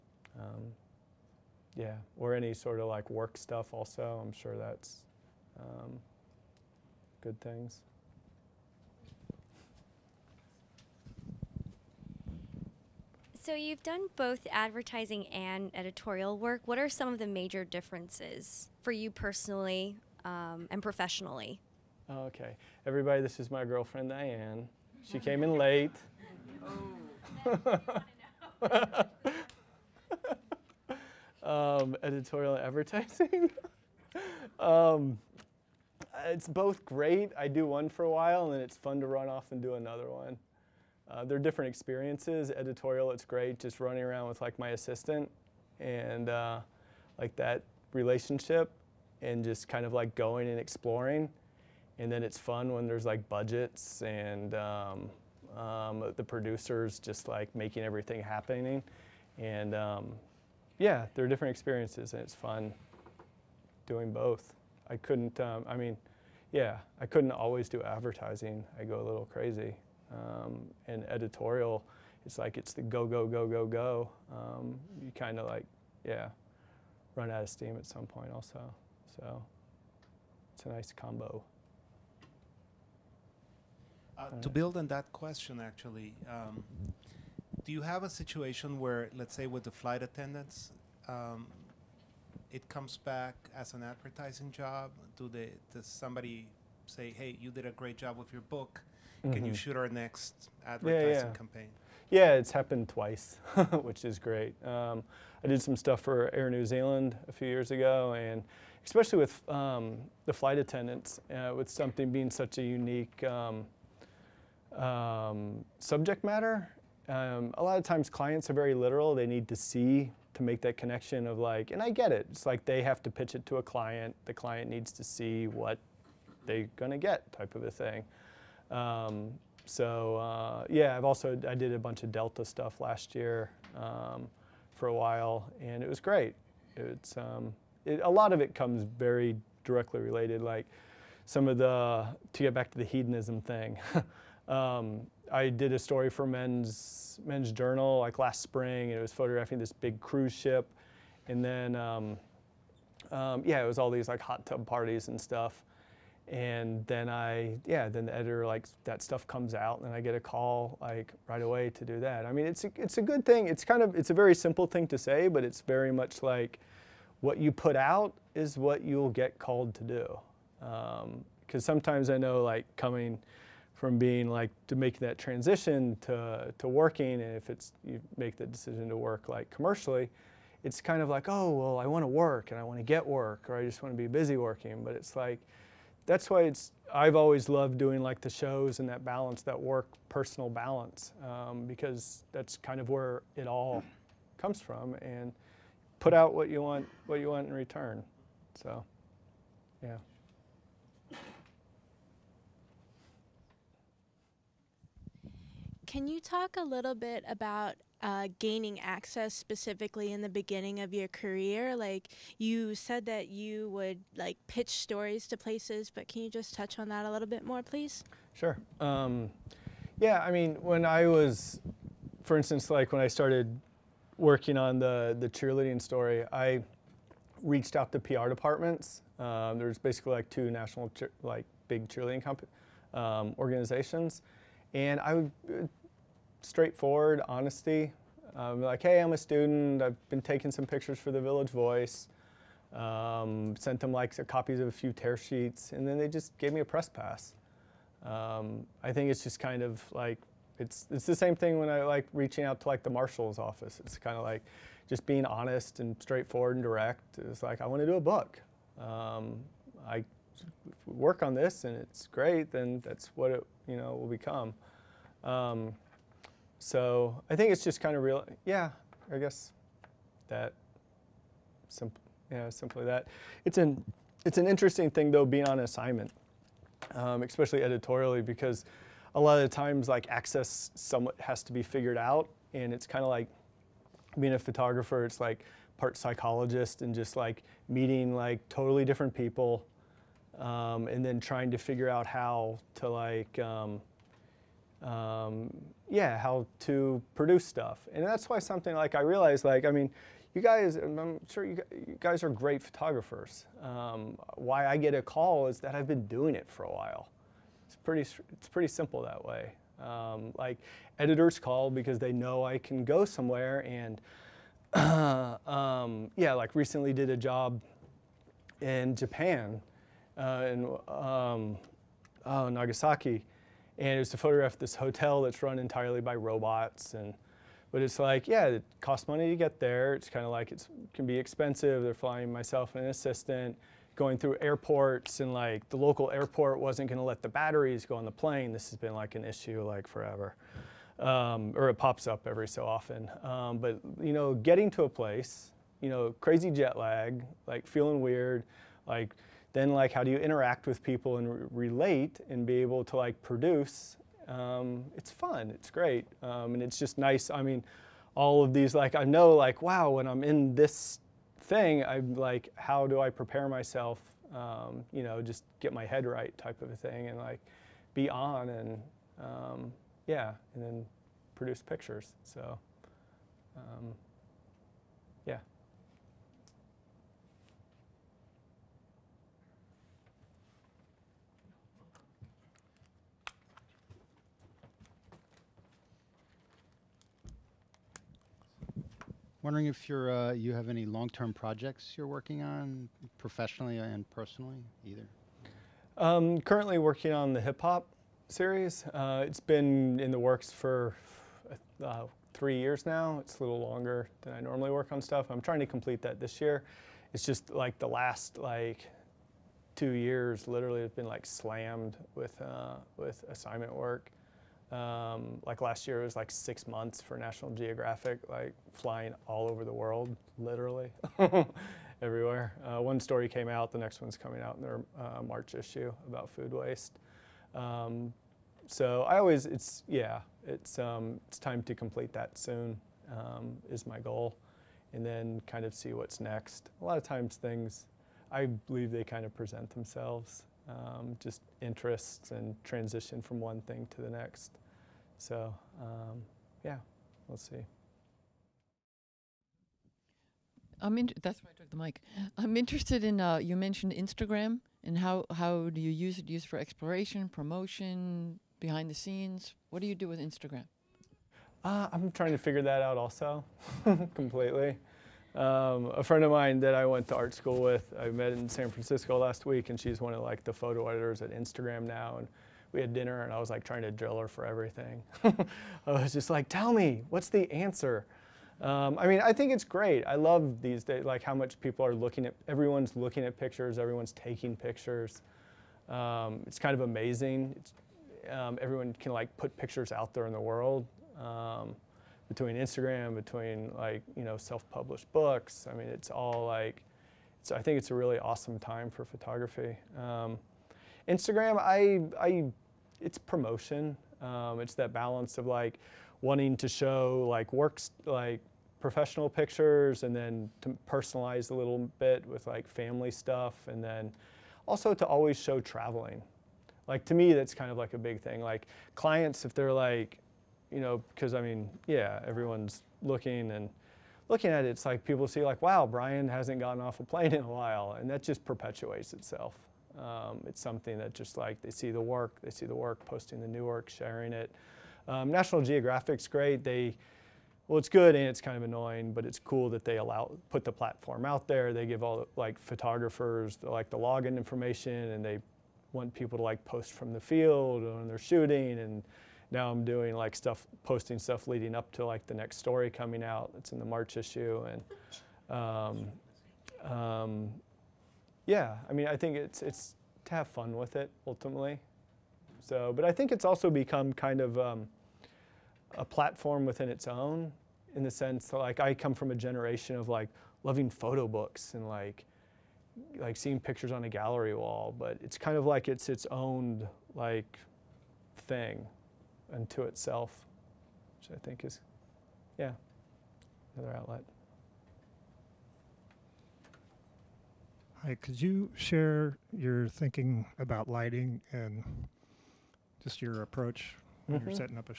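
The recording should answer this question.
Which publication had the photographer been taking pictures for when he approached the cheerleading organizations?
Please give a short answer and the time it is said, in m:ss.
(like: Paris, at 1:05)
the Village Voice, at 4:01.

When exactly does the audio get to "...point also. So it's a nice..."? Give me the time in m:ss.
1:18.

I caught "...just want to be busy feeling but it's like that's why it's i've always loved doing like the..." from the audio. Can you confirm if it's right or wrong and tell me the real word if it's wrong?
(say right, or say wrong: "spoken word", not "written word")
wrong: "working", not "feeling".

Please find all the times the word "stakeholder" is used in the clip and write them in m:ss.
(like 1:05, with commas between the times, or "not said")
not said.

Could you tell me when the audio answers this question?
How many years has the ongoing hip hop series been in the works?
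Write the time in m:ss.
6:42.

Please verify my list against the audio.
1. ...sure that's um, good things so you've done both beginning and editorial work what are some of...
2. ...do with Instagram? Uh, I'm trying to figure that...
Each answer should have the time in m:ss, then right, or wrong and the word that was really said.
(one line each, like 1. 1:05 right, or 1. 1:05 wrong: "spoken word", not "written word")
1. 0:04 wrong: "advertising", not "beginning"
2. 7:39 right.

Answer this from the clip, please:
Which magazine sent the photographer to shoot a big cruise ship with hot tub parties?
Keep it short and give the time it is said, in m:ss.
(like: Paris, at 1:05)
Men's Journal, at 2:27.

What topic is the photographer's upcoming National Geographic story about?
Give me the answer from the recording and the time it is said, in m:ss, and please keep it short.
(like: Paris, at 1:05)
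food waste, at 7:06.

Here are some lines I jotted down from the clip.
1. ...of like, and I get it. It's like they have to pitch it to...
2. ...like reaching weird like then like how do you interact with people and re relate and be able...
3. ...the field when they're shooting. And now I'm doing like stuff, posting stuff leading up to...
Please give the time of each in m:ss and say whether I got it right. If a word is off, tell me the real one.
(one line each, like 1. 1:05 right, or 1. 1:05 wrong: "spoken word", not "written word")
1. 2:01 right
2. 5:47 wrong: "feeling", not "reaching"
3. 9:07 right.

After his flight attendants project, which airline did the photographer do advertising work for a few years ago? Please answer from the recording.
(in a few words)
Air New Zealand.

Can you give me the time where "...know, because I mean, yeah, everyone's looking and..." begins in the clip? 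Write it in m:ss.
8:40.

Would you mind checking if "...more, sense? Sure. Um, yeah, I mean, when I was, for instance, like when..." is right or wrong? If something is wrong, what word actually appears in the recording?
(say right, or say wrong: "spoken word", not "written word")
wrong: "please", not "sense".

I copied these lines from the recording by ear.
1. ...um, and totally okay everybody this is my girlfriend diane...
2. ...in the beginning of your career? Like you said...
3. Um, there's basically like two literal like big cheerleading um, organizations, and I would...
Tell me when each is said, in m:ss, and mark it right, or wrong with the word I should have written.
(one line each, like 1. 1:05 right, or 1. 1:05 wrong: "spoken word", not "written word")
1. 0:20 wrong: "professionally", not "totally"
2. 3:30 right
3. 3:49 wrong: "national", not "literal".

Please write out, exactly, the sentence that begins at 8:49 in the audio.
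Um, it's something that just like they see the work, they see the work, posting the new work, sharing it.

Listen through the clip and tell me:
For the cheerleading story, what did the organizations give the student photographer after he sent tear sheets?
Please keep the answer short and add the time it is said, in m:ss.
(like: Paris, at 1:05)
a press pass, at 4:06.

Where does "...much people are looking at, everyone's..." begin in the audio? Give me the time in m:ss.
8:01.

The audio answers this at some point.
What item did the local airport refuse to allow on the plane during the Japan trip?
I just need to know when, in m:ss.
5:37.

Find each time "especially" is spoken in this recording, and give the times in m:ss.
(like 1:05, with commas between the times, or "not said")
1:48, 4:37.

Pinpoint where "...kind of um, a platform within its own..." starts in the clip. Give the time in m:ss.
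9:24.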